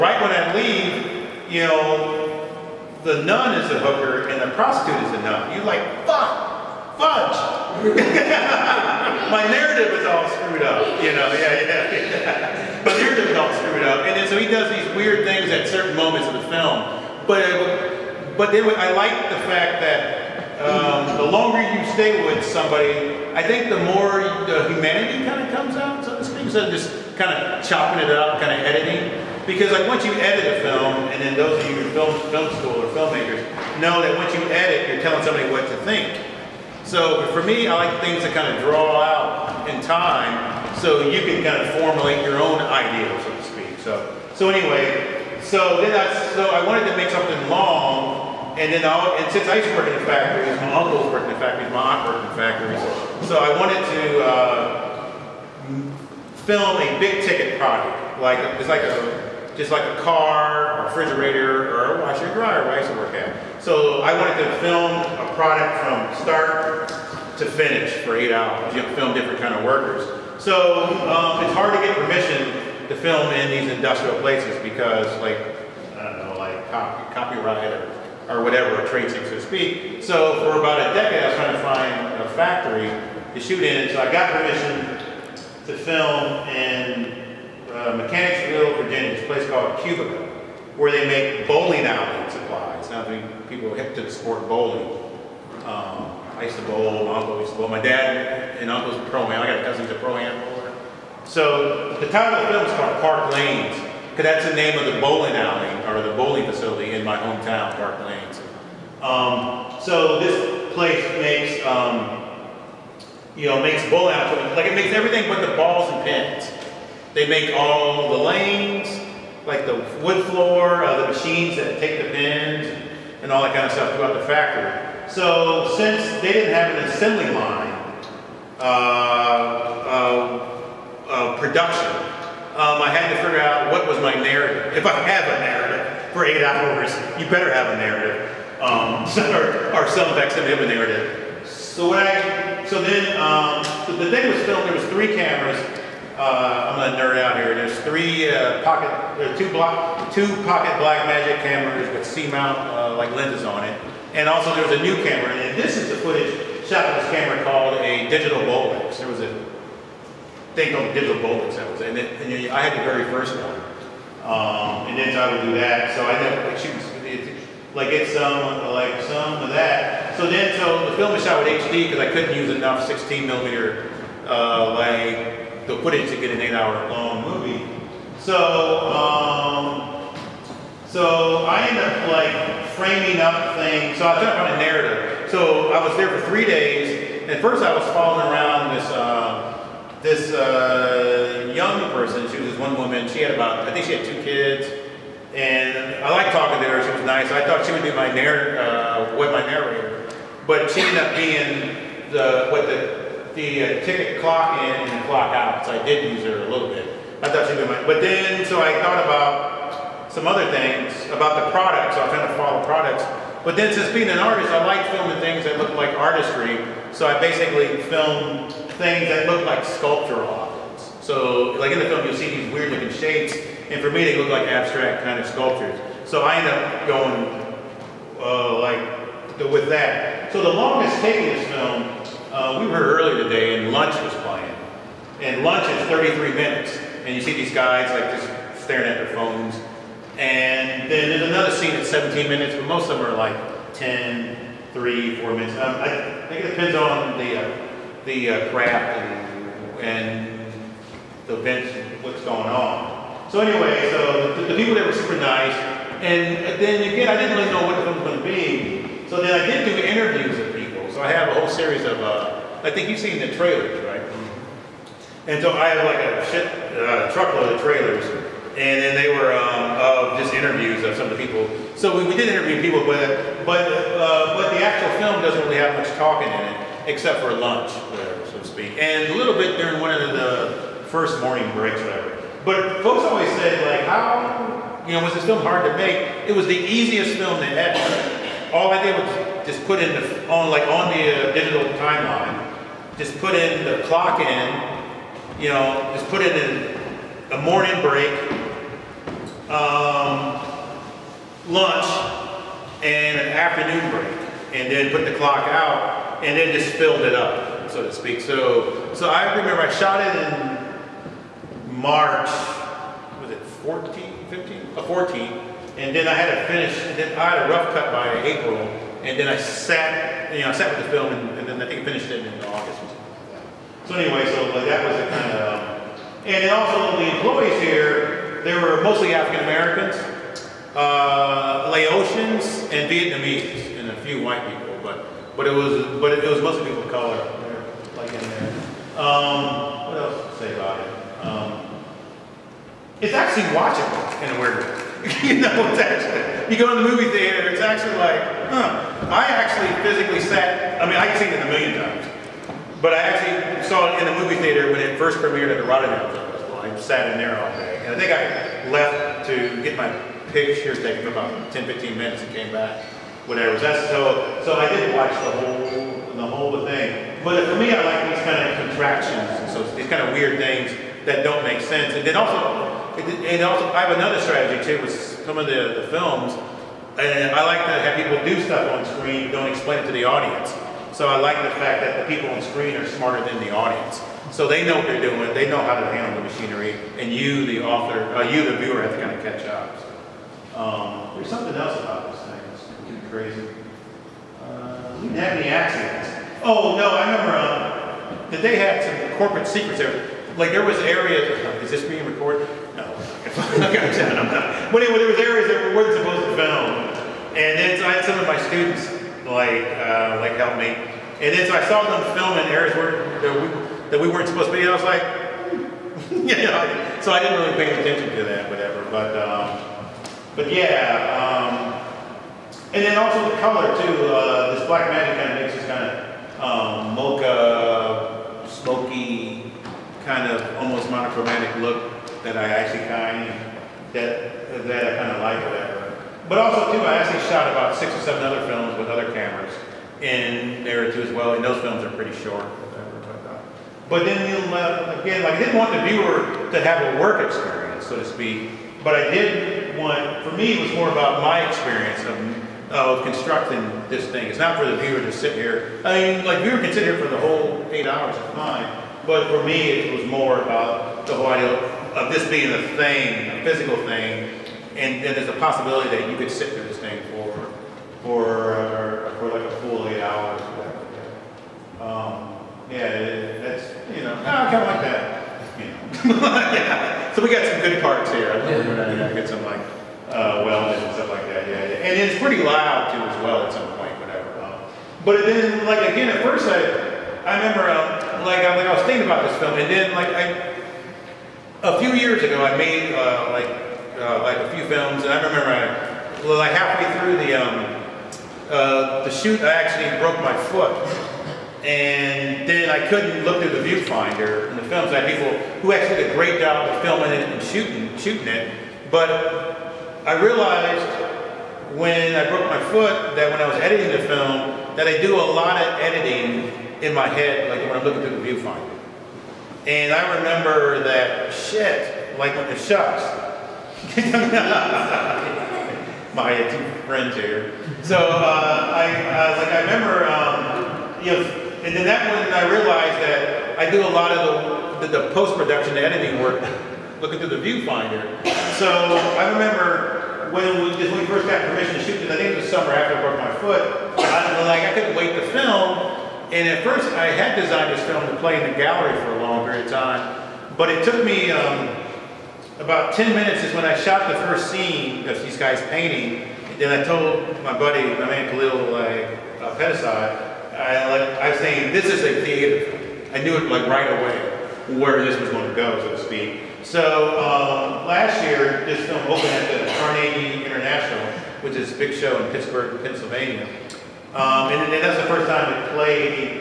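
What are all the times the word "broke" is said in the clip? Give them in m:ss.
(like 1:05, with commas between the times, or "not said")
8:19, 8:32, 9:03.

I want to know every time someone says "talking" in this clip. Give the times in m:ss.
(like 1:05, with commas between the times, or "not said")
3:16, 4:35.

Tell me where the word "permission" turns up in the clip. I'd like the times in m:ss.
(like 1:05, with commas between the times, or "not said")
1:11, 1:24, 9:01.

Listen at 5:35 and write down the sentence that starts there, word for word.
But it was but it, it was mostly people of color like in there.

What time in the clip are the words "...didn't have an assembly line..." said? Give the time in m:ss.
2:06.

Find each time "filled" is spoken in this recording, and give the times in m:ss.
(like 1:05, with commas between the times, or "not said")
5:06.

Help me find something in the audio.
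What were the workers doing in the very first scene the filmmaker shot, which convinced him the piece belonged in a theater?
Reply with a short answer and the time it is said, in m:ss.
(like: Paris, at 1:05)
Painting, at 9:15.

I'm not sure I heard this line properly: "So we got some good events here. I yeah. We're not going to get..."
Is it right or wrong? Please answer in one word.
wrong.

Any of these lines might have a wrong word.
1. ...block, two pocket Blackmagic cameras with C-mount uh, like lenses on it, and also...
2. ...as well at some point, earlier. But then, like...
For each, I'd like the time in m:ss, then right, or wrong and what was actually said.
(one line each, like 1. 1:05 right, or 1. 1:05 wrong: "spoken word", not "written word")
1. 2:29 right
2. 8:03 wrong: "whatever", not "earlier".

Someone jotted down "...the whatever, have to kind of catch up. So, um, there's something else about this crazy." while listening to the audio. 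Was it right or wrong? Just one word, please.
wrong.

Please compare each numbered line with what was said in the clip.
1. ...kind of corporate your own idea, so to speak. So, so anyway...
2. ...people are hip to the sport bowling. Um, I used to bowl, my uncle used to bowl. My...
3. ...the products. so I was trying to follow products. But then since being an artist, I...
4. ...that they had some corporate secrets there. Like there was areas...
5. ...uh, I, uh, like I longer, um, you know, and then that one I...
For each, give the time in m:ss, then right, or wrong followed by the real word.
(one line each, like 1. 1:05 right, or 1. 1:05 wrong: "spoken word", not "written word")
1. 0:41 wrong: "formulate", not "corporate"
2. 1:33 right
3. 3:31 right
4. 6:38 right
5. 8:47 wrong: "remember", not "longer".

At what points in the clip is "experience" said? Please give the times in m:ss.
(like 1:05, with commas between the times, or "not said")
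7:27, 7:31.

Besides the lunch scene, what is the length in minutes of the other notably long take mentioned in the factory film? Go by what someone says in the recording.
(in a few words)
17.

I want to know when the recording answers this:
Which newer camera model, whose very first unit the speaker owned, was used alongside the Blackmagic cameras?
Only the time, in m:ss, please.
2:38.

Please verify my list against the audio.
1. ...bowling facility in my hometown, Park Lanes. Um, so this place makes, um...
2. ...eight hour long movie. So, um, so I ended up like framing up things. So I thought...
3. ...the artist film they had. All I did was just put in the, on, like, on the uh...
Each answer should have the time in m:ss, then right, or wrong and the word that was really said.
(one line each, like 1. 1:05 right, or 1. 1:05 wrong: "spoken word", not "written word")
1. 1:46 right
2. 2:56 right
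3. 4:46 wrong: "easiest", not "artist".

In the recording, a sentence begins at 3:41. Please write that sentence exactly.
So like in the film, you'll see these weird looking shapes, and for me, they look like abstract kind of sculptures.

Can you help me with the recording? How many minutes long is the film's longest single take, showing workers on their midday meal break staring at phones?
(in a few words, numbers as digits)
33.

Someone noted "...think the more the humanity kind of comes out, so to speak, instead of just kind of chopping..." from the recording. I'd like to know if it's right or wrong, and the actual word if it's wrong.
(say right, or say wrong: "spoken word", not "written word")
right.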